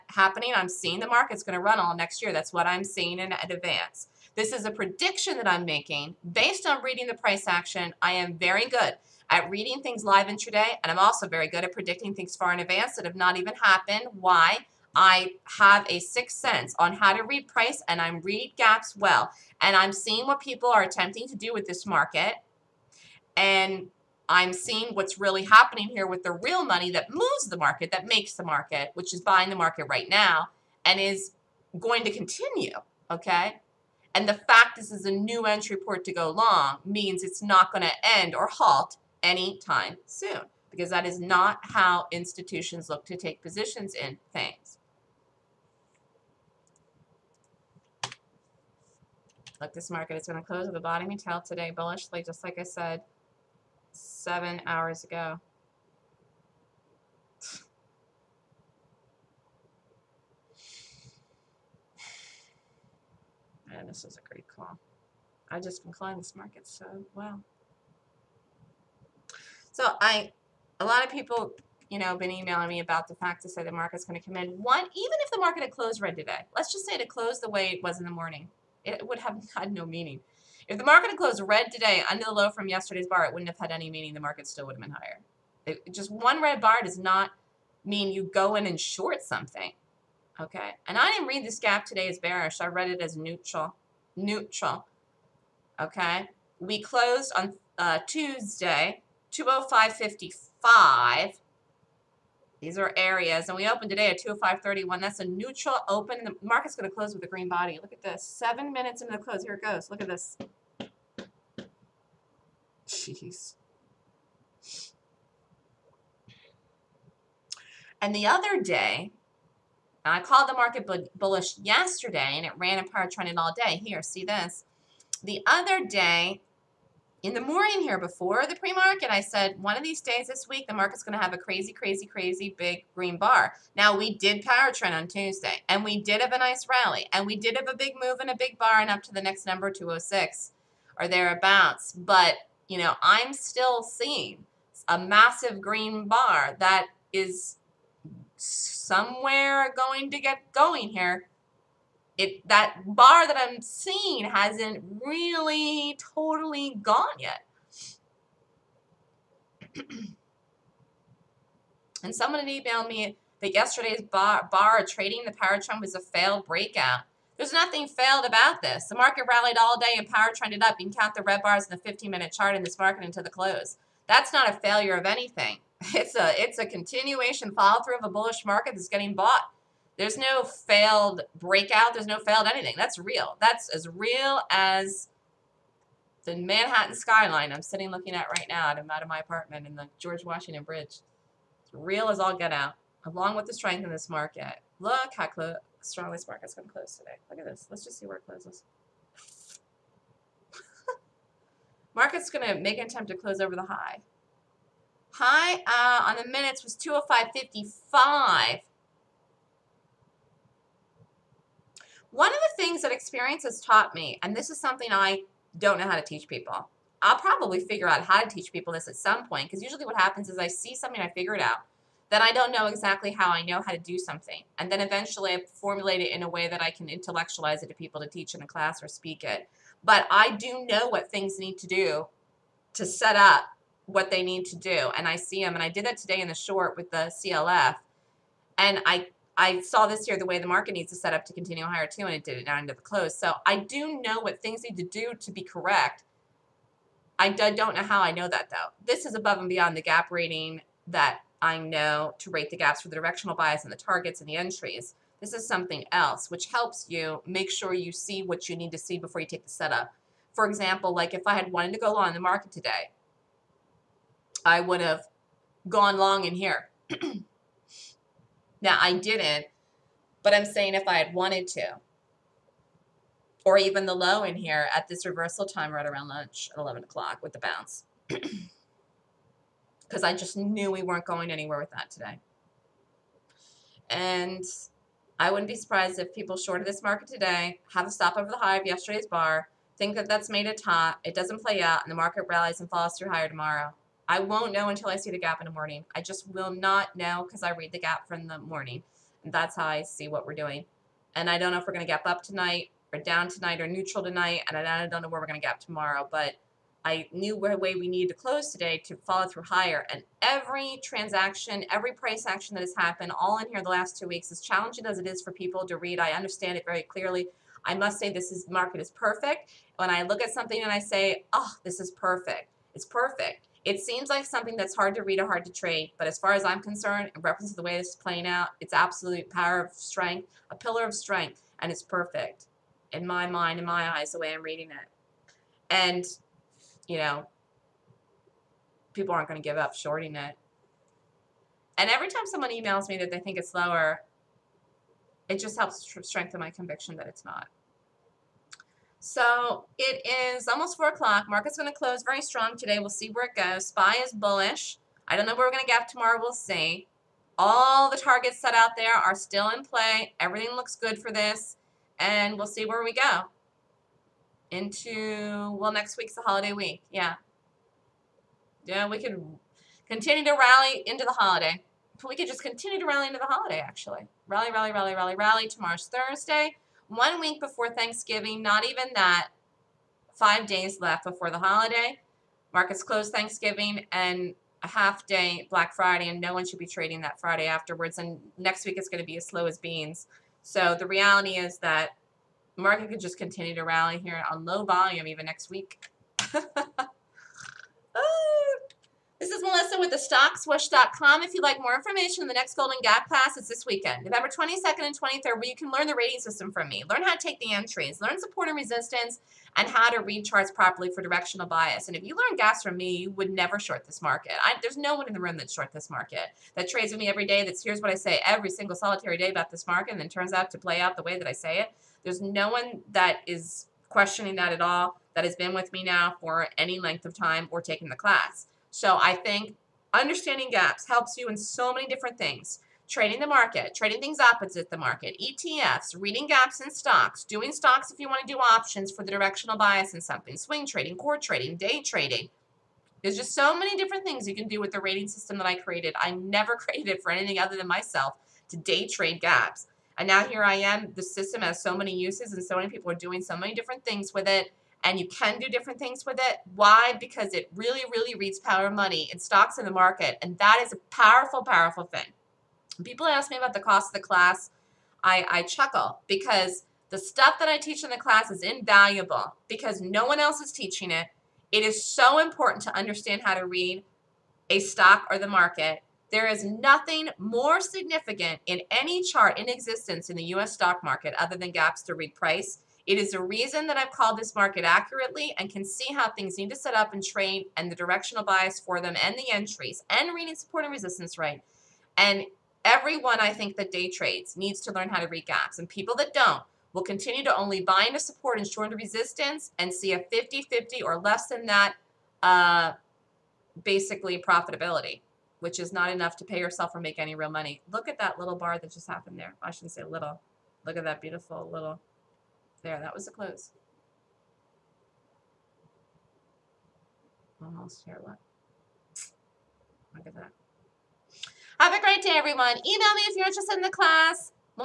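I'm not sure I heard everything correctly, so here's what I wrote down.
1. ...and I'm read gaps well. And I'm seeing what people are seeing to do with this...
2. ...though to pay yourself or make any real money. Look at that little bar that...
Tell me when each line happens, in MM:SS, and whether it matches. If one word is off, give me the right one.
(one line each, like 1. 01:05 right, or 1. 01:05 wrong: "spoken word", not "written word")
1. 00:17 wrong: "attempting", not "seeing"
2. 08:25 wrong: "enough", not "though".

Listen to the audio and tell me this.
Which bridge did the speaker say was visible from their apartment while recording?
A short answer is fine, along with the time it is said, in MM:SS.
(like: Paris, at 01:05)
George Washington Bridge, at 03:09.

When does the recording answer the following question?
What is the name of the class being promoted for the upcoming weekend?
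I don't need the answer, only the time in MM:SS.
06:42.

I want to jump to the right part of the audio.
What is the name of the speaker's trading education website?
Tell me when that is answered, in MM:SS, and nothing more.
06:39.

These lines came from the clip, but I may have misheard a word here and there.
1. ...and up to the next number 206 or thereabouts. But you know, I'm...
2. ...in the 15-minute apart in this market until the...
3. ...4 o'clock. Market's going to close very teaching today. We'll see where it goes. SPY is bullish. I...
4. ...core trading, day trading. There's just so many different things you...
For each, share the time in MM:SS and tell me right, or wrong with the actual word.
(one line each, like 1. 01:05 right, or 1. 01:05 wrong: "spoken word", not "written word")
1. 02:18 right
2. 02:51 wrong: "chart", not "apart"
3. 05:50 wrong: "strong", not "teaching"
4. 07:20 right.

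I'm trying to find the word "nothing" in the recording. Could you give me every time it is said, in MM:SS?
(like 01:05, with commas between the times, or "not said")
02:47, 07:56.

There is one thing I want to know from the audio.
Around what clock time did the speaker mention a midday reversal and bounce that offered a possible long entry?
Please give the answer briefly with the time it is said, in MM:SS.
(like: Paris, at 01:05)
11 o'clock, at 04:36.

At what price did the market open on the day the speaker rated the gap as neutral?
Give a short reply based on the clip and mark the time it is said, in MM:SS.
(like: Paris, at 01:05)
205.31, at 01:44.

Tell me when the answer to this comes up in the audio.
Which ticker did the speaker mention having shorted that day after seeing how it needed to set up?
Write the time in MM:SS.
03:57.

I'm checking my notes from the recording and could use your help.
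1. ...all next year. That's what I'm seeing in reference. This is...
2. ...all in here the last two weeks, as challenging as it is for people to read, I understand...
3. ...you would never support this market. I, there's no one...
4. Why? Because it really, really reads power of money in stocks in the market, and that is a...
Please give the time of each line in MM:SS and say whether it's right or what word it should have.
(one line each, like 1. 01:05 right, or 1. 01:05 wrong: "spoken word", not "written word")
1. 00:01 wrong: "advance", not "reference"
2. 05:13 right
3. 06:52 wrong: "short", not "support"
4. 07:36 right.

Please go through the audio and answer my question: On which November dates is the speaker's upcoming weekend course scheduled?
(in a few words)
November 22nd and 23rd.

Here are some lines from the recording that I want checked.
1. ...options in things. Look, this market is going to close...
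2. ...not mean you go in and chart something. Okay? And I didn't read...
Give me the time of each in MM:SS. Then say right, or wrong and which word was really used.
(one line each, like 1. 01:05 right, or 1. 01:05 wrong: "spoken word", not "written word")
1. 00:43 wrong: "positions", not "options"
2. 01:26 wrong: "short", not "chart".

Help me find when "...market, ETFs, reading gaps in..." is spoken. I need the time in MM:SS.
07:14.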